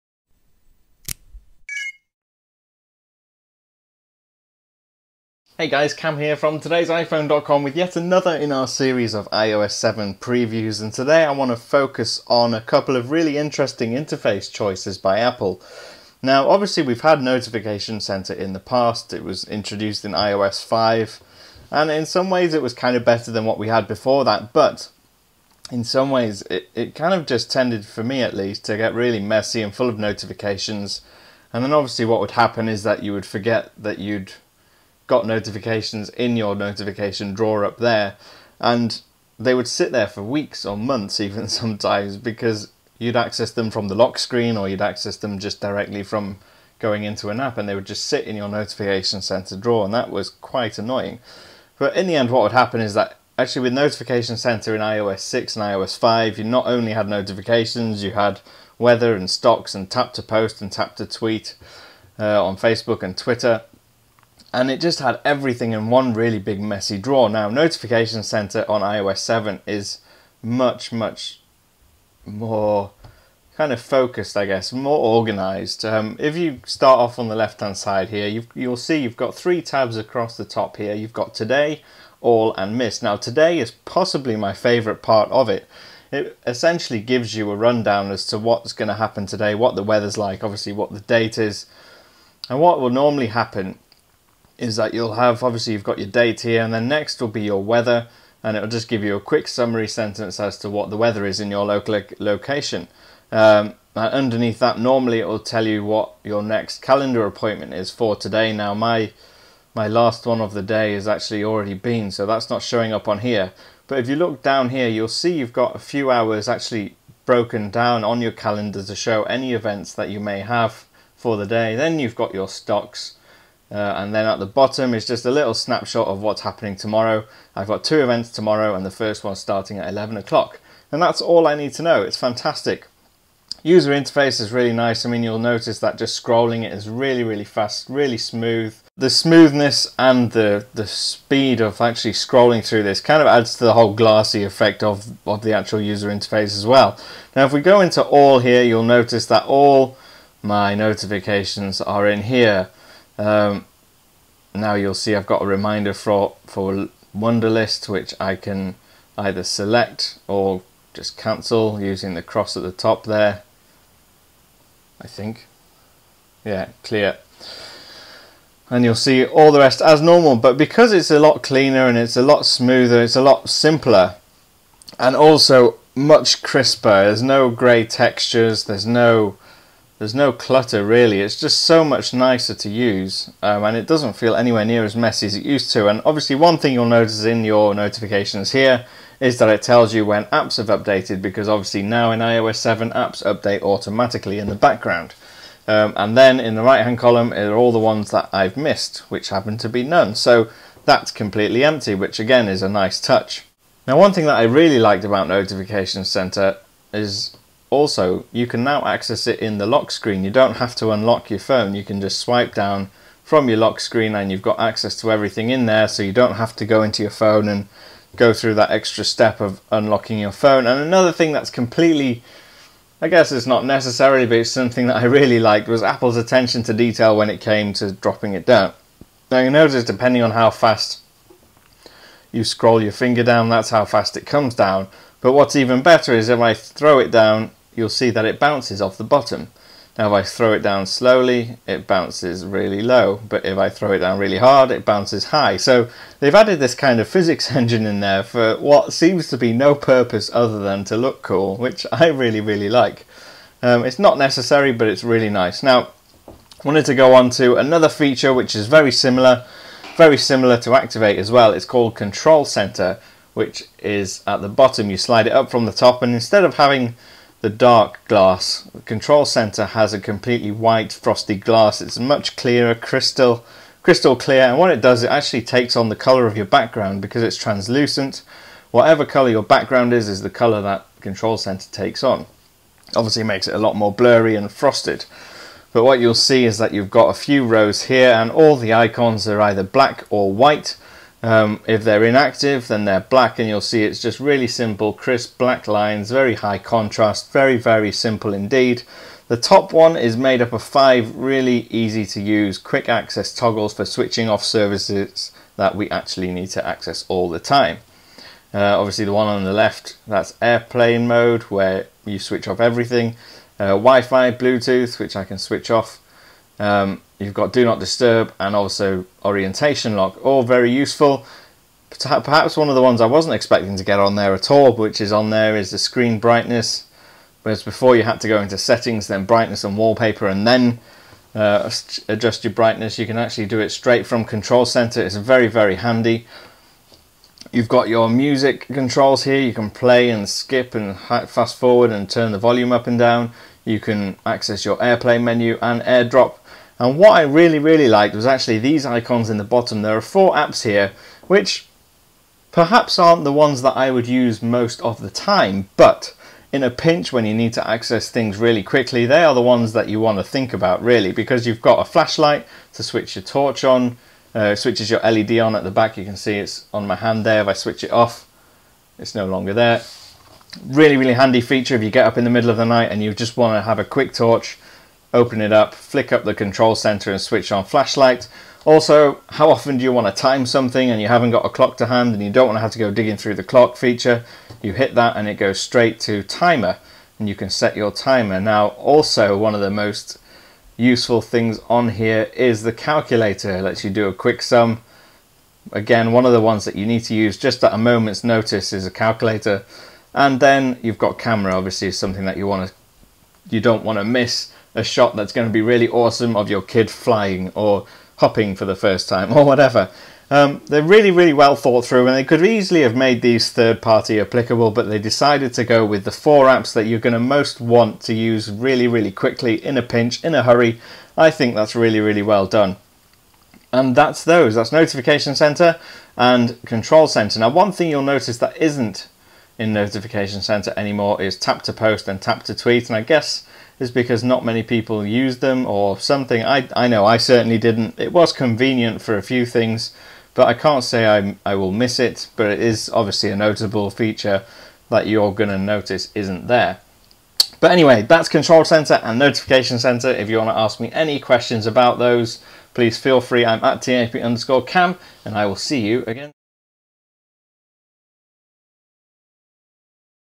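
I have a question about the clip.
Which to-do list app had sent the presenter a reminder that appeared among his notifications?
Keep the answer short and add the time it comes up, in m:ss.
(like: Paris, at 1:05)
Wunderlist, at 2:37.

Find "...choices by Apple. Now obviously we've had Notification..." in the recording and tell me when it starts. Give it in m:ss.
0:14.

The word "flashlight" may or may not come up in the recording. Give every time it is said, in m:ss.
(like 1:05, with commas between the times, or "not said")
6:01, 6:17.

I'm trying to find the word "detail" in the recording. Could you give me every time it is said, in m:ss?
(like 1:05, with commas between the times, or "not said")
3:46.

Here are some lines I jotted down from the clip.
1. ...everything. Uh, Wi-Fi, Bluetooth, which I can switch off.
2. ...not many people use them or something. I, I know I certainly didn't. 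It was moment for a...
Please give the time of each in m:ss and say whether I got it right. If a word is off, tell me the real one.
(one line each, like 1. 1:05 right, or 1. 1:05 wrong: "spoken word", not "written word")
1. 5:12 right
2. 7:14 wrong: "convenient", not "moment".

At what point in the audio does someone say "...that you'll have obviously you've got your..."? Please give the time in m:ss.
1:34.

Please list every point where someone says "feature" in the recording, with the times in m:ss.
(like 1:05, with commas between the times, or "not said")
4:17, 6:11, 6:23, 7:23.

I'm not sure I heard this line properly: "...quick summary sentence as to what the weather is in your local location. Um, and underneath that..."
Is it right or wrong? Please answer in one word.
right.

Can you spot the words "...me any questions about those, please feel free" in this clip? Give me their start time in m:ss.
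7:30.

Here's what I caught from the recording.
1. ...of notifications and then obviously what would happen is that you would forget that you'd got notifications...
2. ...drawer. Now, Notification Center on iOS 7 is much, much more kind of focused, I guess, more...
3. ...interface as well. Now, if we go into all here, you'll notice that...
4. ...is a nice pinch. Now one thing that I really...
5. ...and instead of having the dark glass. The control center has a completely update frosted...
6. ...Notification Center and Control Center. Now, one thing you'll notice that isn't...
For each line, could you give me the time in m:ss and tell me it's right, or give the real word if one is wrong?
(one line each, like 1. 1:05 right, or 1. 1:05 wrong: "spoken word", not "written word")
1. 0:29 right
2. 1:06 right
3. 2:26 right
4. 3:22 wrong: "touch", not "pinch"
5. 4:26 wrong: "white", not "update"
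6. 7:04 right.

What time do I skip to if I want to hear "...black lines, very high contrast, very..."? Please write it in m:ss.
4:55.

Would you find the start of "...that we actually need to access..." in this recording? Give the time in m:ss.
5:05.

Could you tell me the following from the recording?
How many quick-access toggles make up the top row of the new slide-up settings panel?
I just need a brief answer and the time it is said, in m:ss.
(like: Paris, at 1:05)
5, at 5:00.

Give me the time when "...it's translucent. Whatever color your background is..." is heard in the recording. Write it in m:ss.
4:37.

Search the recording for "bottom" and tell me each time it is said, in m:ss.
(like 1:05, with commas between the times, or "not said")
2:04, 3:59, 4:24, 5:49.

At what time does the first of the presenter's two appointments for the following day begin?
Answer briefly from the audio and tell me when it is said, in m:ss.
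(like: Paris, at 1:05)
11 o'clock, at 2:09.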